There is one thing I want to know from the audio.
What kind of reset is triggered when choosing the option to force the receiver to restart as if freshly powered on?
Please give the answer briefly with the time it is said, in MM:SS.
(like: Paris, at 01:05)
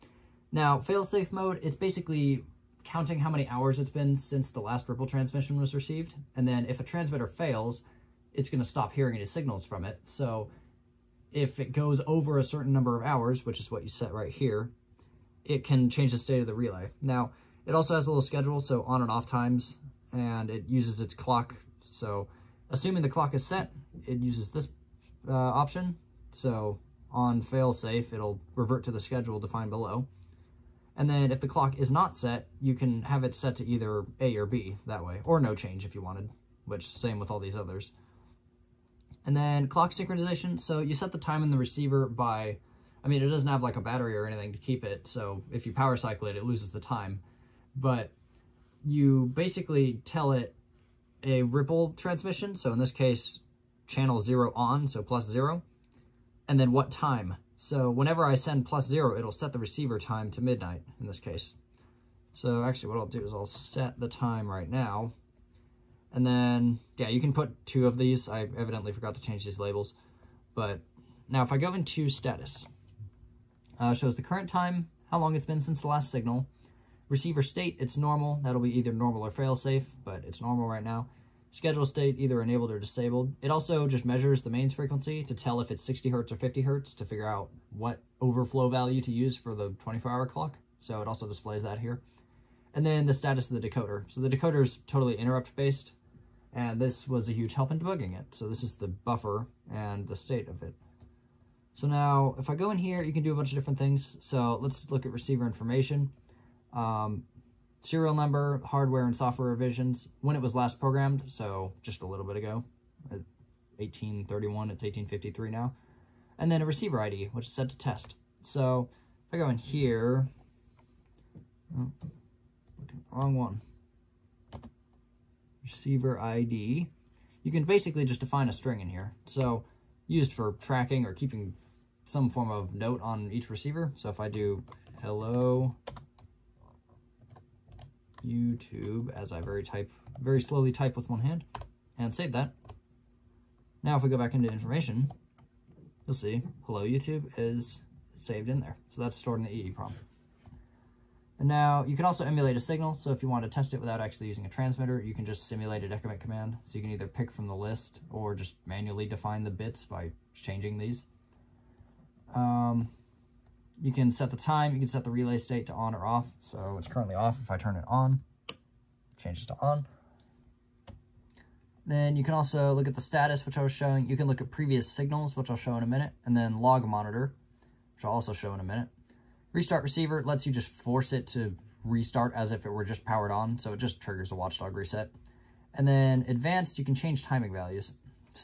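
watchdog reset, at 03:04.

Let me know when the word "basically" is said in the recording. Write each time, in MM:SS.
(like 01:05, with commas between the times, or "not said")
00:01, 00:49, 02:07.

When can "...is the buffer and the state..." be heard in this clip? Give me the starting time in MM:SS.
01:38.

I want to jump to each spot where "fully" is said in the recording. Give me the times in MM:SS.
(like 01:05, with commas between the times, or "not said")
not said.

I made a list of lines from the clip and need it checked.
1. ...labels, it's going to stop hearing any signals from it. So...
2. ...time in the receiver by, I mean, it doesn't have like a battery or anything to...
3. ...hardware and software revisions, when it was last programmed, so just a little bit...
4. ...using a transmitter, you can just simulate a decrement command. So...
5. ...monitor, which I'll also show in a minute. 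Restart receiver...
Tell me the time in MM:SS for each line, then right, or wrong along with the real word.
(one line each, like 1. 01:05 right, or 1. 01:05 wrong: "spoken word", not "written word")
1. 00:07 wrong: "fails", not "labels"
2. 00:41 right
3. 01:48 right
4. 02:34 right
5. 02:56 right.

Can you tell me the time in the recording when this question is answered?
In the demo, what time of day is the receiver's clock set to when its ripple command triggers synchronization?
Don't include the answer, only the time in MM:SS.
01:00.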